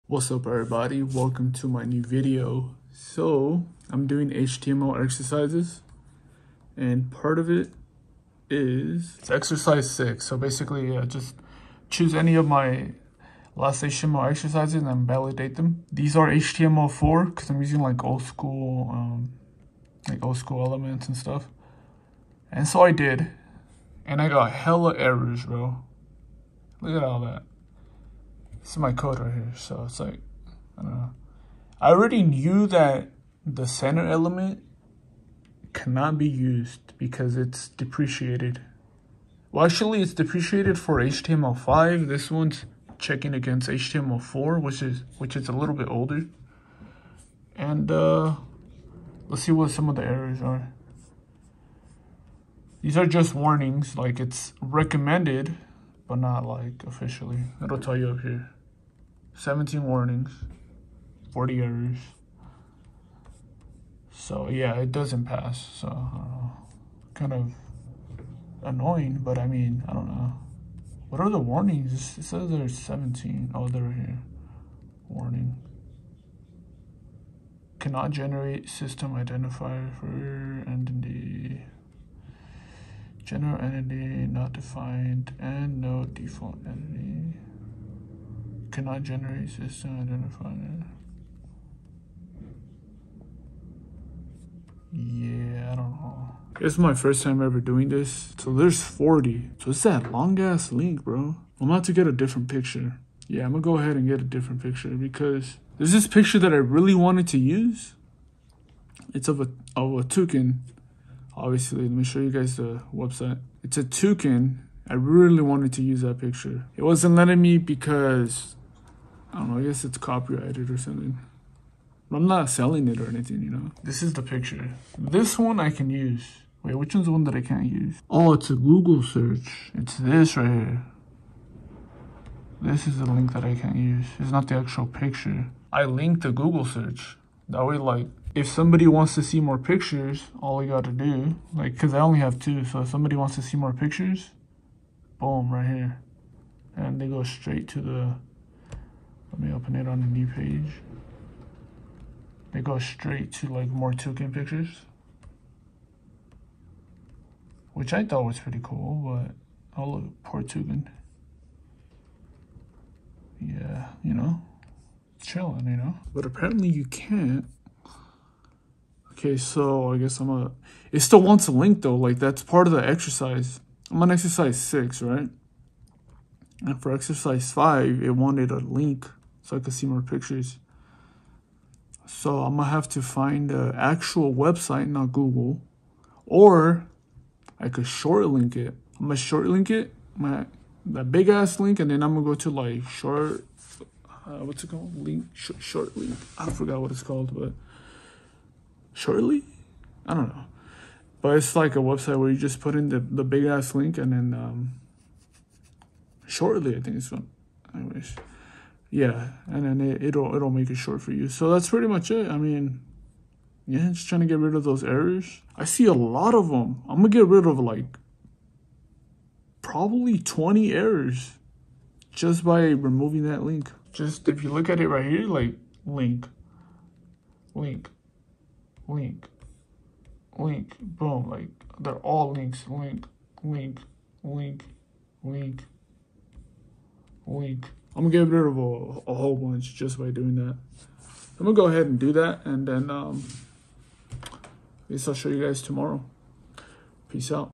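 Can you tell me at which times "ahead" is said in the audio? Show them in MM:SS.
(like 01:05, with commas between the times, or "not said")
01:43, 04:01.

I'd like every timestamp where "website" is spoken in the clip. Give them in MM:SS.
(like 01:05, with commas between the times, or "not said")
01:52, 03:04, 03:21.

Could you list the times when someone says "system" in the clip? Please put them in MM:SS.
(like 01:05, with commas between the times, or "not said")
01:18, 01:29.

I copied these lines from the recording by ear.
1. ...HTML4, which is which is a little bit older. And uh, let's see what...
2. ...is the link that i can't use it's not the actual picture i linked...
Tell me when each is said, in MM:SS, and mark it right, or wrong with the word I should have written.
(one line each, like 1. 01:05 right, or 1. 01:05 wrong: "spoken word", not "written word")
1. 00:43 right
2. 02:12 right.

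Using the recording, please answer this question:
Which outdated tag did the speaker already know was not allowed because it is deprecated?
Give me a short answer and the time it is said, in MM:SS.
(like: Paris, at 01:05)
center, at 00:33.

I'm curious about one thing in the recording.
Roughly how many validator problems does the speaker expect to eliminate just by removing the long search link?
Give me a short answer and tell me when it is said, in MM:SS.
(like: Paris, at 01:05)
20, at 03:40.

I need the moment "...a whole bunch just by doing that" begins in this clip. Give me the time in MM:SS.
03:59.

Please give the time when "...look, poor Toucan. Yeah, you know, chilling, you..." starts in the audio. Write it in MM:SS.
02:39.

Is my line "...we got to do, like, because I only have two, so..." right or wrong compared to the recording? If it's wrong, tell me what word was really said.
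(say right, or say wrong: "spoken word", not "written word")
right.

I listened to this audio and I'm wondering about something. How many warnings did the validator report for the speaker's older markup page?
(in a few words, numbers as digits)
17.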